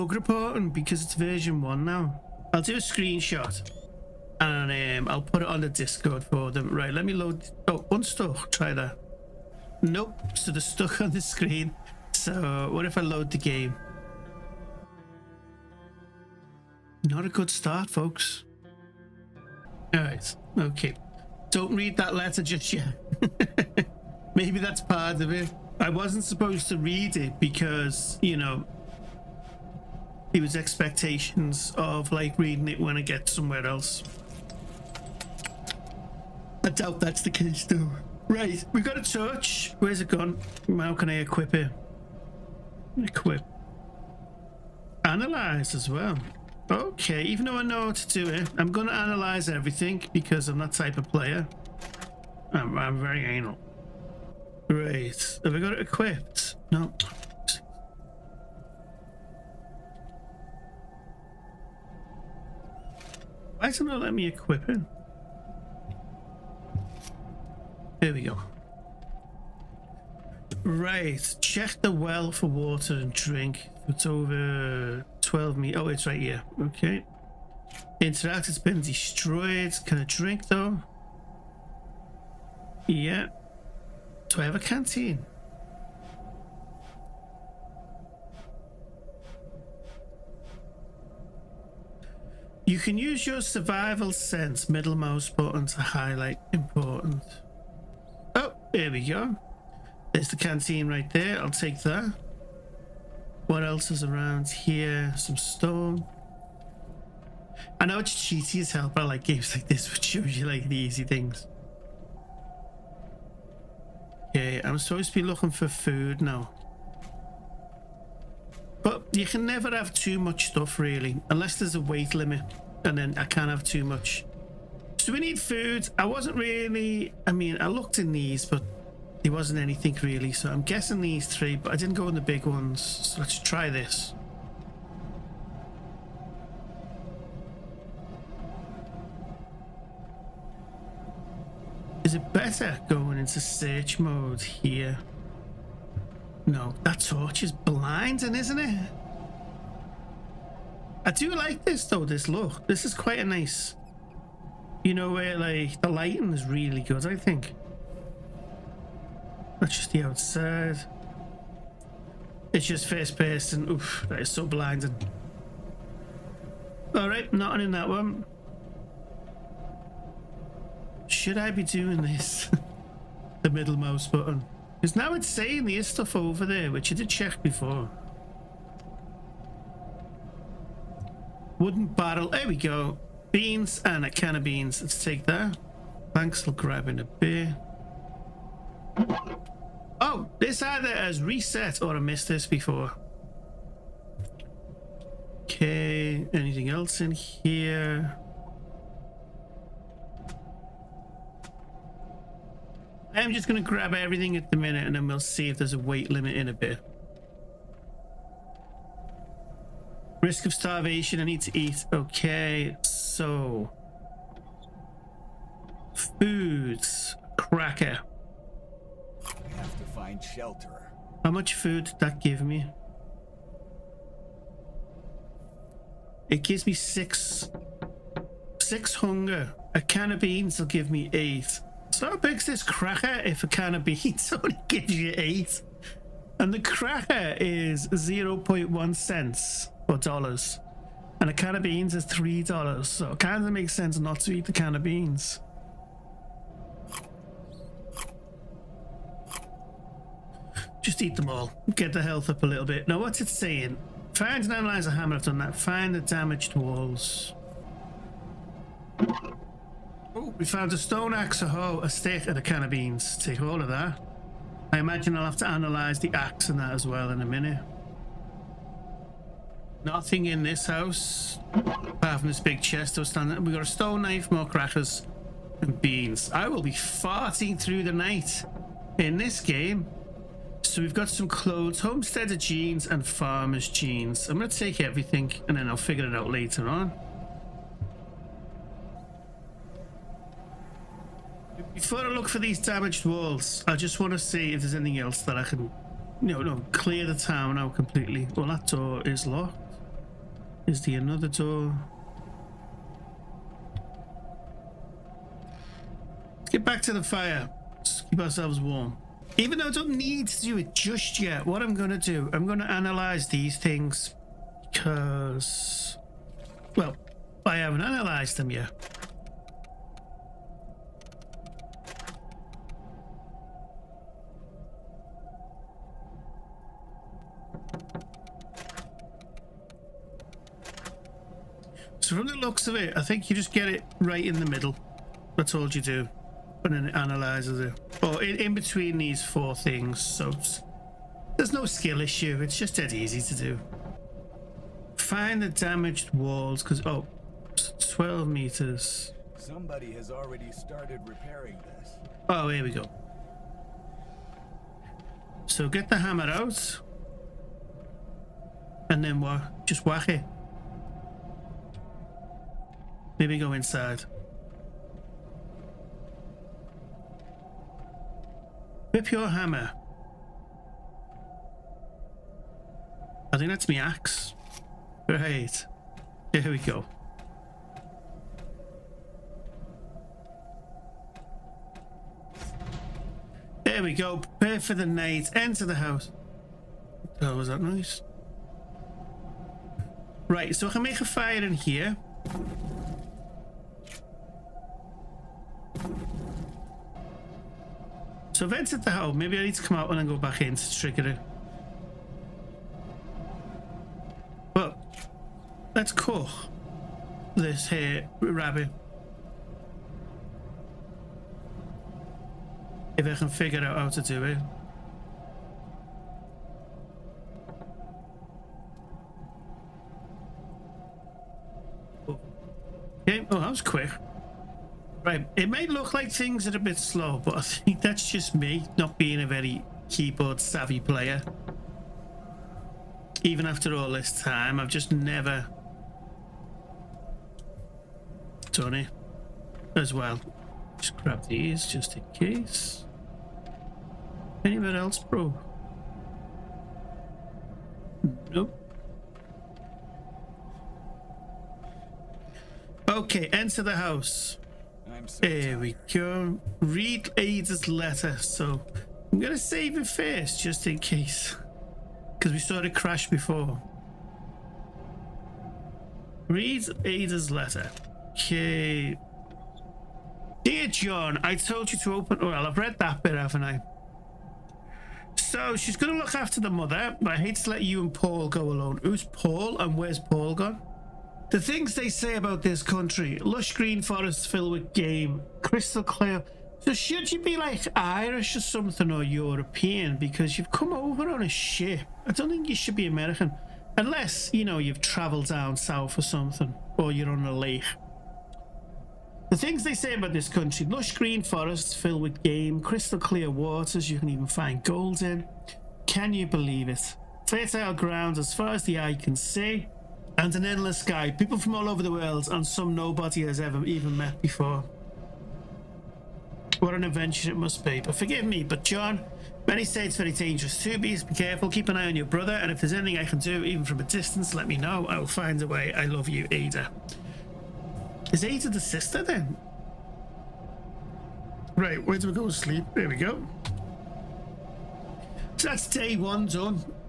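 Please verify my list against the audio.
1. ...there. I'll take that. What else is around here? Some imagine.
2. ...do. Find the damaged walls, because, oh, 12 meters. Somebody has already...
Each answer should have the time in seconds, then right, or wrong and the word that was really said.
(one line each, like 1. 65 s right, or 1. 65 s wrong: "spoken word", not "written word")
1. 101 s wrong: "stone", not "imagine"
2. 343 s right.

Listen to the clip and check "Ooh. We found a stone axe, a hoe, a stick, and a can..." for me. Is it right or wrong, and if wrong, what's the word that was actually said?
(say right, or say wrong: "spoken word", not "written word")
right.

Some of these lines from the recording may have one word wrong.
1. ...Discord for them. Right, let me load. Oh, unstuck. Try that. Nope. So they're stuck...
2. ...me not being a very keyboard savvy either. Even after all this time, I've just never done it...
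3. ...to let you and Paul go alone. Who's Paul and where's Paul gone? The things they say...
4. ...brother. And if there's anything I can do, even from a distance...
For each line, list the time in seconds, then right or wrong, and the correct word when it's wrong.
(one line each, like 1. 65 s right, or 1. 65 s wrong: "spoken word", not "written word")
1. 5 s right
2. 428 s wrong: "player", not "either"
3. 477 s right
4. 522 s right.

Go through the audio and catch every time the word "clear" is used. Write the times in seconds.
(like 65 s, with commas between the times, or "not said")
296 s, 485 s, 502 s.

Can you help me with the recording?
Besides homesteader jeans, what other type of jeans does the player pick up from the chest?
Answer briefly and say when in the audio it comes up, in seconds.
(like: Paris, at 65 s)
Farmer's jeans, at 283 s.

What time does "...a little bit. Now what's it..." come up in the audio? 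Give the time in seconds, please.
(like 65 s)
252 s.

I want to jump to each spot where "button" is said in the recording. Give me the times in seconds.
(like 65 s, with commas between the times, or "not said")
95 s, 174 s.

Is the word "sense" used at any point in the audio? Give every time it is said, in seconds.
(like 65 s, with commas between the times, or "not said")
94 s, 243 s.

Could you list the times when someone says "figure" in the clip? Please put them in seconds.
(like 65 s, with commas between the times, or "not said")
285 s, 413 s.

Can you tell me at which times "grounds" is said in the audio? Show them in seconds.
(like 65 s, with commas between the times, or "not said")
507 s.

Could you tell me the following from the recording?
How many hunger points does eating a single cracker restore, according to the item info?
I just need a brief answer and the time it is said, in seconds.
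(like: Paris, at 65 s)
6, at 228 s.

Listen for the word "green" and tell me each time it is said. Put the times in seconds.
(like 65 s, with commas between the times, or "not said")
483 s, 500 s.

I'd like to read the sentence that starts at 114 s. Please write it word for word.
Okay, I'm supposed to be looking for food now.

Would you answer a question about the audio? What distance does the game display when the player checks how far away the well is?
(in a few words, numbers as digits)
12 meters.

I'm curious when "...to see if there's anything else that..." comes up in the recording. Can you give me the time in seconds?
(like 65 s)
294 s.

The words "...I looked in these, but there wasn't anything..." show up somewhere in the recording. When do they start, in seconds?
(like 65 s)
127 s.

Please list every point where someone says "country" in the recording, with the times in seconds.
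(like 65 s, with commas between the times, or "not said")
482 s, 500 s.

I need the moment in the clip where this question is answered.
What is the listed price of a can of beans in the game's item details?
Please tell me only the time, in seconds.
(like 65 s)
242 s.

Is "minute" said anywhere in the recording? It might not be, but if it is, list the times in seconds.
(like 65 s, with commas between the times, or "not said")
204 s, 267 s.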